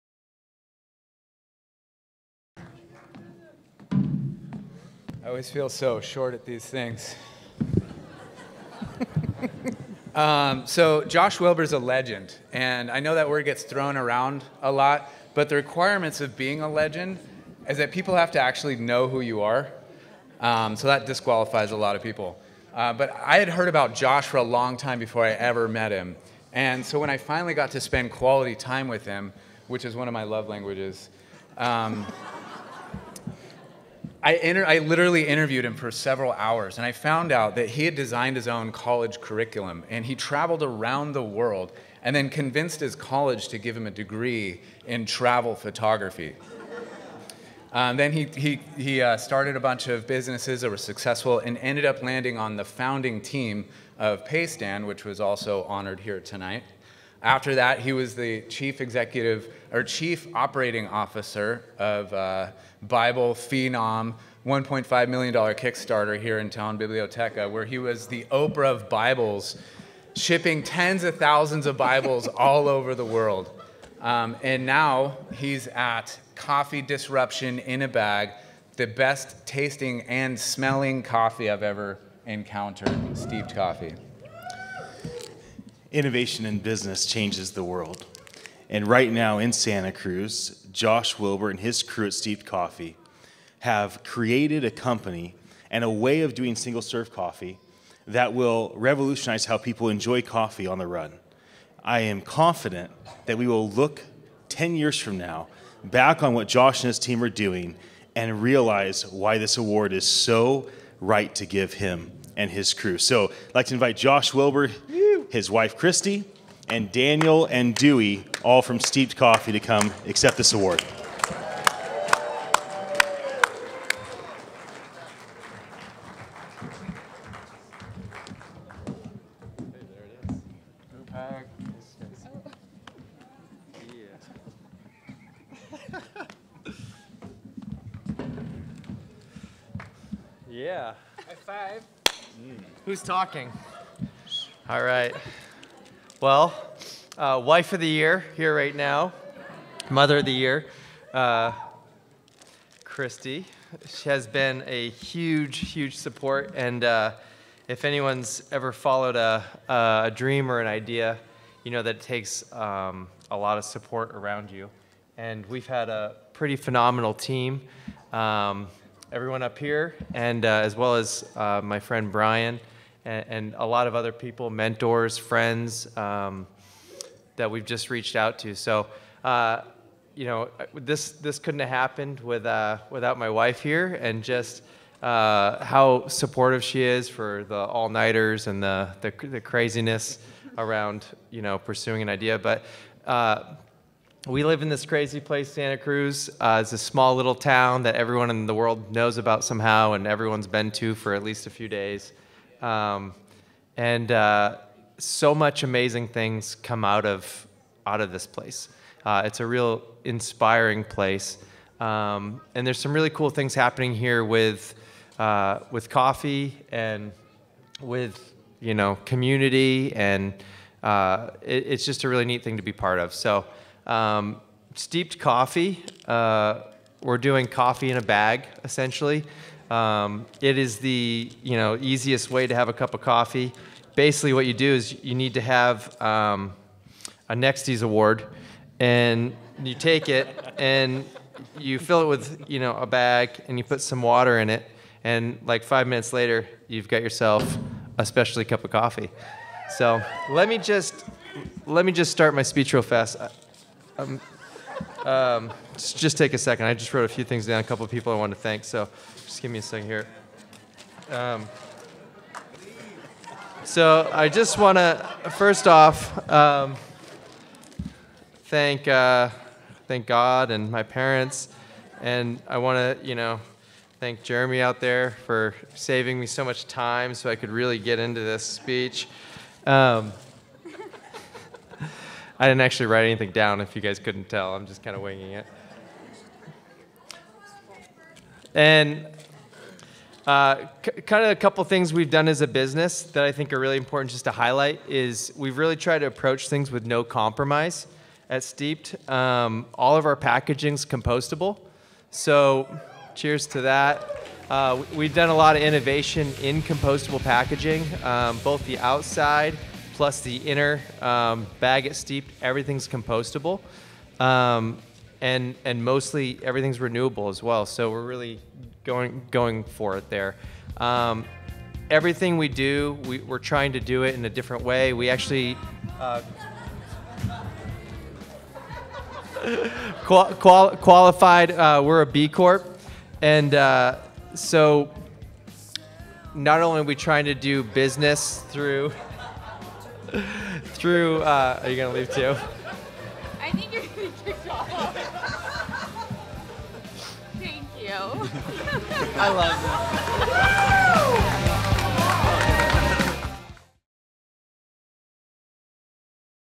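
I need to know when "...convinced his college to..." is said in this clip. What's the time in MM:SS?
00:42.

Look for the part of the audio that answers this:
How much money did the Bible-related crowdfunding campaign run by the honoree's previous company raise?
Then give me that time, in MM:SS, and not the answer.
01:04.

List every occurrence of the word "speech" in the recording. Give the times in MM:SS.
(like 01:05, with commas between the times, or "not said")
04:12, 04:38.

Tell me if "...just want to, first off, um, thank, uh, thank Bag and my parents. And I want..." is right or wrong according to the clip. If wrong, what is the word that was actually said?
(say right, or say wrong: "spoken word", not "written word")
wrong: "God", not "Bag".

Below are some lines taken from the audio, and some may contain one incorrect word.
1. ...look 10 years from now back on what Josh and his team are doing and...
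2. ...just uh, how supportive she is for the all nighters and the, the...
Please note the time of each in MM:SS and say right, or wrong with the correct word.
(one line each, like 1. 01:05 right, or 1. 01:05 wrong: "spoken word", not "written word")
1. 01:43 right
2. 03:04 right.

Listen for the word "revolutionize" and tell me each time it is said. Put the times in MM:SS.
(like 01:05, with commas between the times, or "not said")
01:38.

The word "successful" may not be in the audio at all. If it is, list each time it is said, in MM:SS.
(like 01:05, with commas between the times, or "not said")
00:50.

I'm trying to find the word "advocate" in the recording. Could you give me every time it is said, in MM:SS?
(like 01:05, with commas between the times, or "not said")
not said.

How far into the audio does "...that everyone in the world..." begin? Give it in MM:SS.
03:17.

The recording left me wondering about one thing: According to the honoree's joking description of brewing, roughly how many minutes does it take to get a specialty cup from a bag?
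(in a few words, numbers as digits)
5.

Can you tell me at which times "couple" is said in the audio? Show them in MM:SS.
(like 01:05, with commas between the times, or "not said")
04:17, 04:51.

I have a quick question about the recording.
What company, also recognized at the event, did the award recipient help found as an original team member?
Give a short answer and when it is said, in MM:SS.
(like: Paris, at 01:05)
Paystand, at 00:54.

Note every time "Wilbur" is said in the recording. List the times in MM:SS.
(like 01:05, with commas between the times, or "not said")
00:11, 01:31, 01:54.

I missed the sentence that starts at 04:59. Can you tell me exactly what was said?
Um, all of our packaging's compostable.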